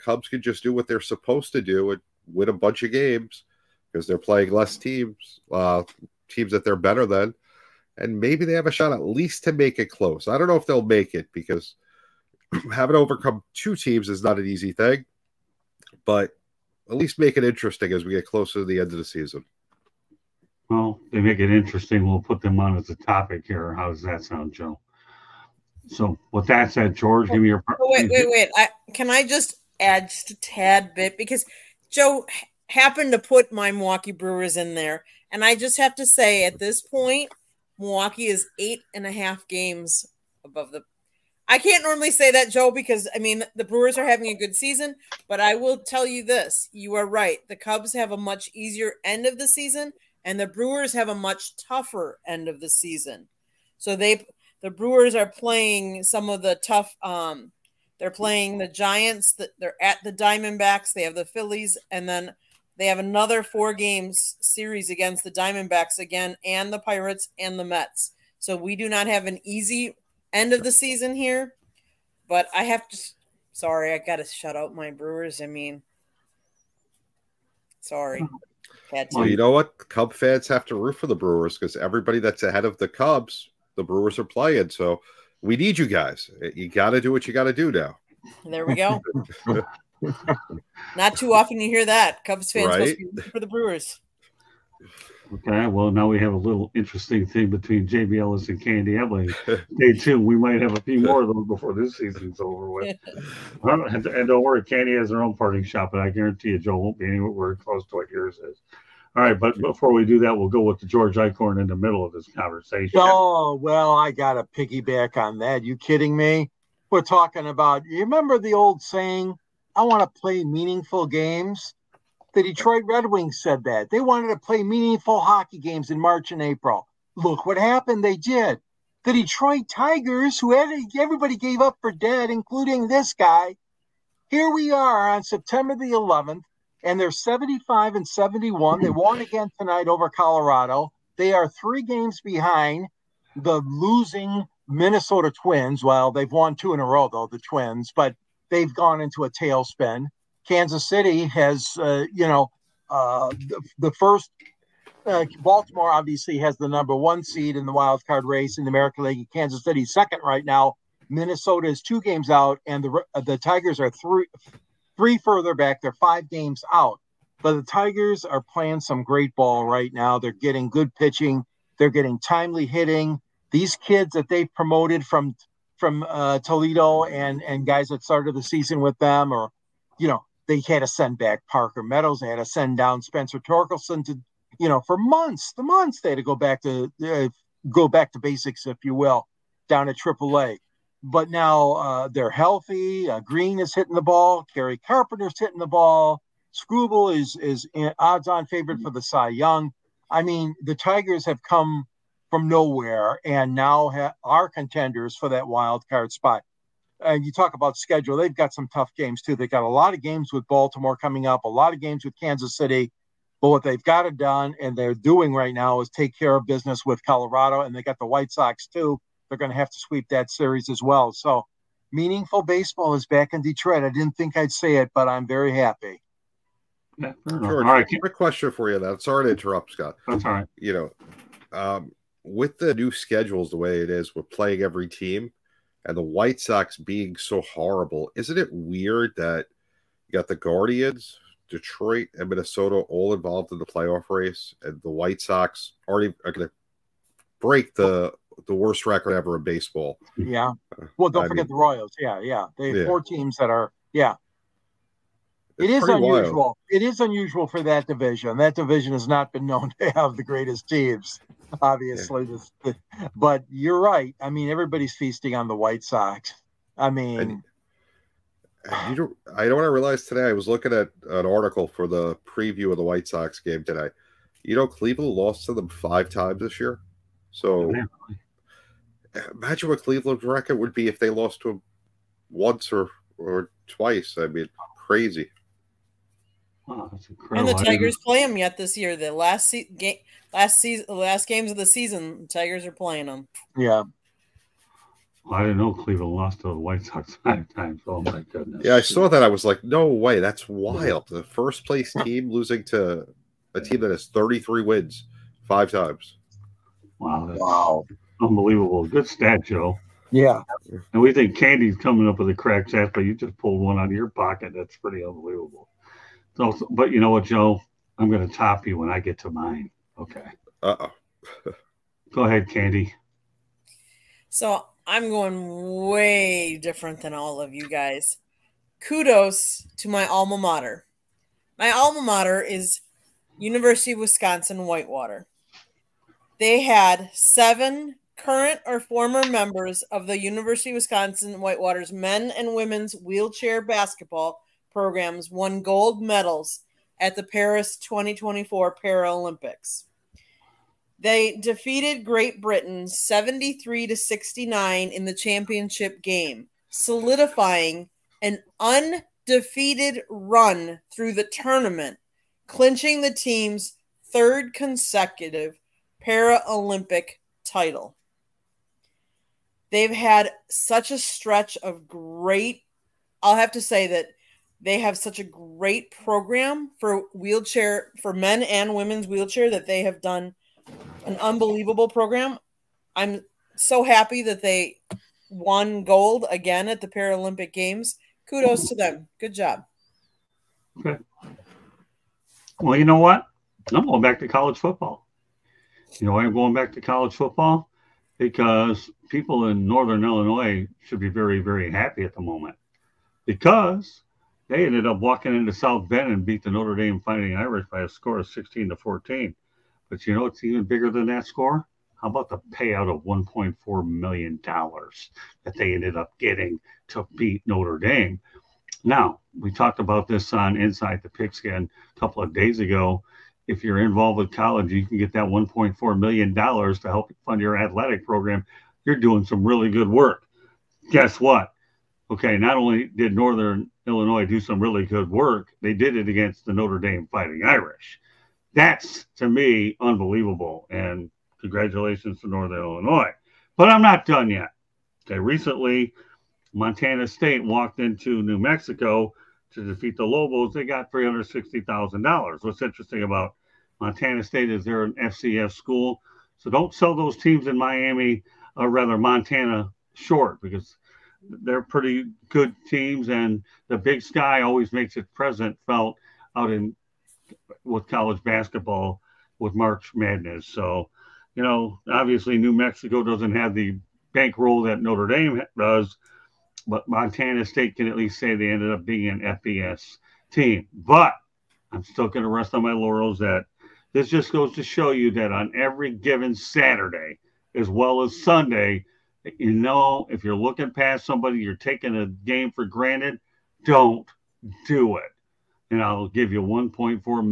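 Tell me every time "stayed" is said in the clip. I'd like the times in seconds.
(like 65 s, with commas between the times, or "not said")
not said.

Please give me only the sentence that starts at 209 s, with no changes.
They have got a lot of games with Baltimore coming up, a lot of games with Kansas City.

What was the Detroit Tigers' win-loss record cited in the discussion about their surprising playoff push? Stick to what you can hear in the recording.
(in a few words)
75 and 71.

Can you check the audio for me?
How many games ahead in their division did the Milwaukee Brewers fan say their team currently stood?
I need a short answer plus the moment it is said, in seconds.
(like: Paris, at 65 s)
8.5, at 38 s.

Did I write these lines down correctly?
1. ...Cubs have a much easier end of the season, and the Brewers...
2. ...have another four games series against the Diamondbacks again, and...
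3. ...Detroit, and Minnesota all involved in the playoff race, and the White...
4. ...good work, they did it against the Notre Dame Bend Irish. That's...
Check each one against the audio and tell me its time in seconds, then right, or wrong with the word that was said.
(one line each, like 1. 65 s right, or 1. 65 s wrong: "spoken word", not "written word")
1. 47 s right
2. 62 s right
3. 241 s right
4. 434 s wrong: "Fighting", not "Bend".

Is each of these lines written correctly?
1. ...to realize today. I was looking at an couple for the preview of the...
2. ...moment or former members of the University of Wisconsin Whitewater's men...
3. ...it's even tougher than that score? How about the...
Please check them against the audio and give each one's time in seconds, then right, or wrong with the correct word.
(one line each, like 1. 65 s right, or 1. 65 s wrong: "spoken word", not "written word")
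1. 269 s wrong: "article", not "couple"
2. 338 s wrong: "current", not "moment"
3. 410 s wrong: "bigger", not "tougher".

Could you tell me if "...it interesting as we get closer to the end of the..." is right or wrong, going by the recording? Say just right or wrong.
right.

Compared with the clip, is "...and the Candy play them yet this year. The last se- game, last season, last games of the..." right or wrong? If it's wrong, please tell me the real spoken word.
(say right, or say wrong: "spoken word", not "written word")
wrong: "Tigers", not "Candy".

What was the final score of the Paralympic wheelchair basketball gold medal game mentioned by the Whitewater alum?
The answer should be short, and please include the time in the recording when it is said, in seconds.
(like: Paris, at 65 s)
73 to 69, at 352 s.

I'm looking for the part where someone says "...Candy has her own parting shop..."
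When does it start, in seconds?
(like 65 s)
104 s.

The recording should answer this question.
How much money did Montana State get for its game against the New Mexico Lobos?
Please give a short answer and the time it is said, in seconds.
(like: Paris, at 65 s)
$360,000, at 450 s.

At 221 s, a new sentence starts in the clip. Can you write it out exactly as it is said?
So, meaningful baseball is back in Detroit.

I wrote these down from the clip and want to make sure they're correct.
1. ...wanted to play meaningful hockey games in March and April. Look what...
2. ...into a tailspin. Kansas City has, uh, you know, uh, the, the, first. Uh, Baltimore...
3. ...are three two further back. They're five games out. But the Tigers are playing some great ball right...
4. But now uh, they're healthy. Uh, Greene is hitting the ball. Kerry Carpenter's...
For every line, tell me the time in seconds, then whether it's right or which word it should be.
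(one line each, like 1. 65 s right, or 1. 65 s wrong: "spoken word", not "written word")
1. 123 s right
2. 148 s right
3. 163 s wrong: "three", not "two"
4. 191 s right.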